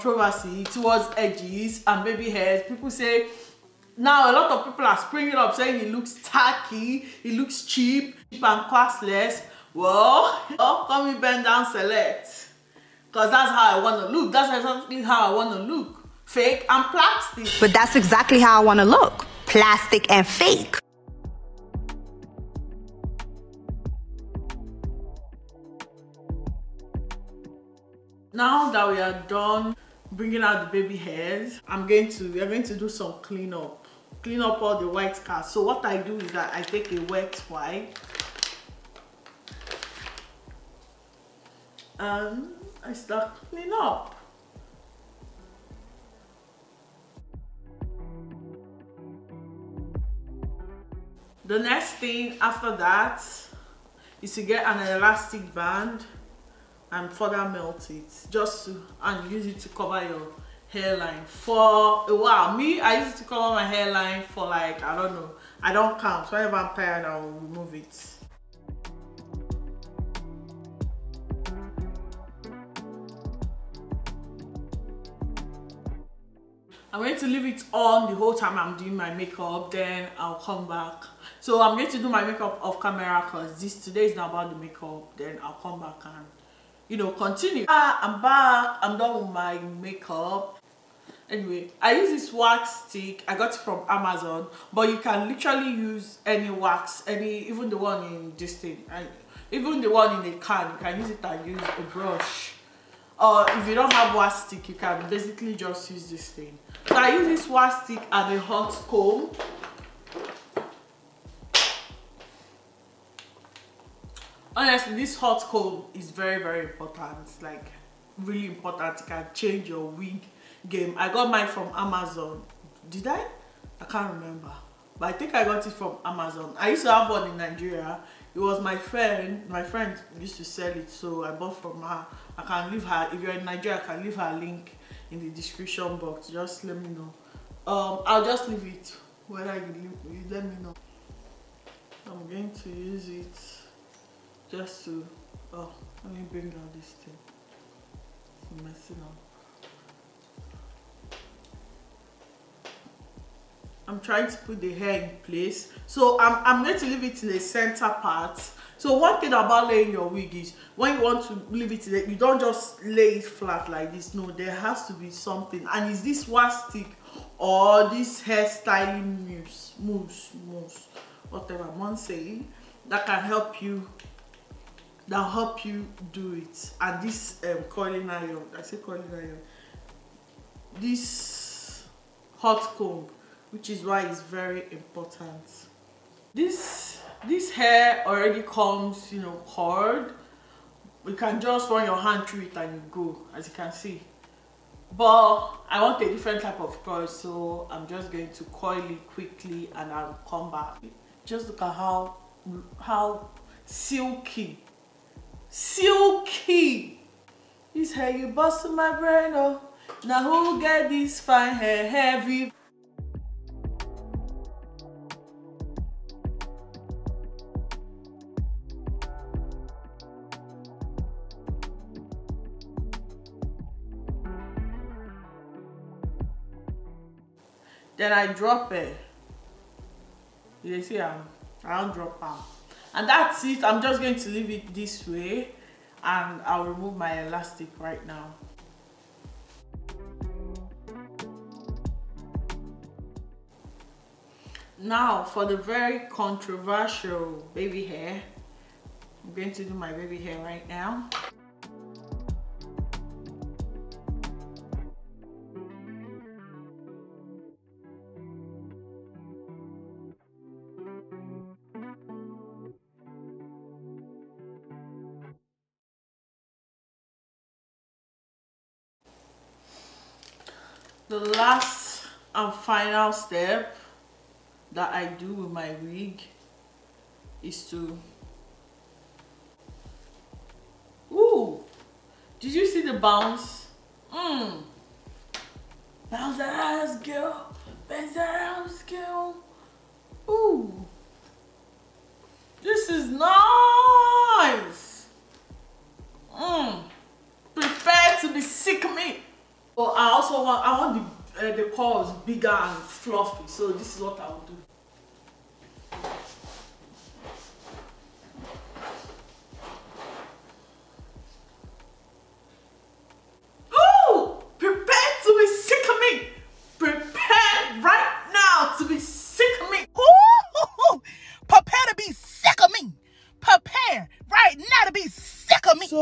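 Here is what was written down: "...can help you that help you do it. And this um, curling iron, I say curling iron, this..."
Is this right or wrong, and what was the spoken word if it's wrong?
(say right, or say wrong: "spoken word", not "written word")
right.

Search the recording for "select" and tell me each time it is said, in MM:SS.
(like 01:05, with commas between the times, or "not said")
00:11.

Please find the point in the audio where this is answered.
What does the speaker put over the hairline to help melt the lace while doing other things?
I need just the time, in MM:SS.
00:54.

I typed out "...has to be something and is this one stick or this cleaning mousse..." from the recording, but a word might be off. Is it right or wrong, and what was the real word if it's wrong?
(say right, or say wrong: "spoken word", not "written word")
wrong: "hairstyling", not "cleaning".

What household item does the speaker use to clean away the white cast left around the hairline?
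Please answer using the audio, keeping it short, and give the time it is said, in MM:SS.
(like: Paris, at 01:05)
Wet wipe, at 00:37.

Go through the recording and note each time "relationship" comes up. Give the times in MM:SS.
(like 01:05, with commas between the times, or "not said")
not said.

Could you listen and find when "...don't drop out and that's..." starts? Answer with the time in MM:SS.
03:51.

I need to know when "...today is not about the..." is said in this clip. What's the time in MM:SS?
01:23.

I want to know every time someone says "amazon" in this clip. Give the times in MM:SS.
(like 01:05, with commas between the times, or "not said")
01:33, 02:01, 02:06.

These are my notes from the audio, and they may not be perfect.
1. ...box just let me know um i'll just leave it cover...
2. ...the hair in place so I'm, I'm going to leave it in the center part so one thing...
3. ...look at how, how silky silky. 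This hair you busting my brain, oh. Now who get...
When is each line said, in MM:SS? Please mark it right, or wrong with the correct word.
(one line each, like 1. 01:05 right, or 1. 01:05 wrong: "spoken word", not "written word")
1. 02:15 wrong: "whether", not "cover"
2. 02:34 right
3. 03:21 right.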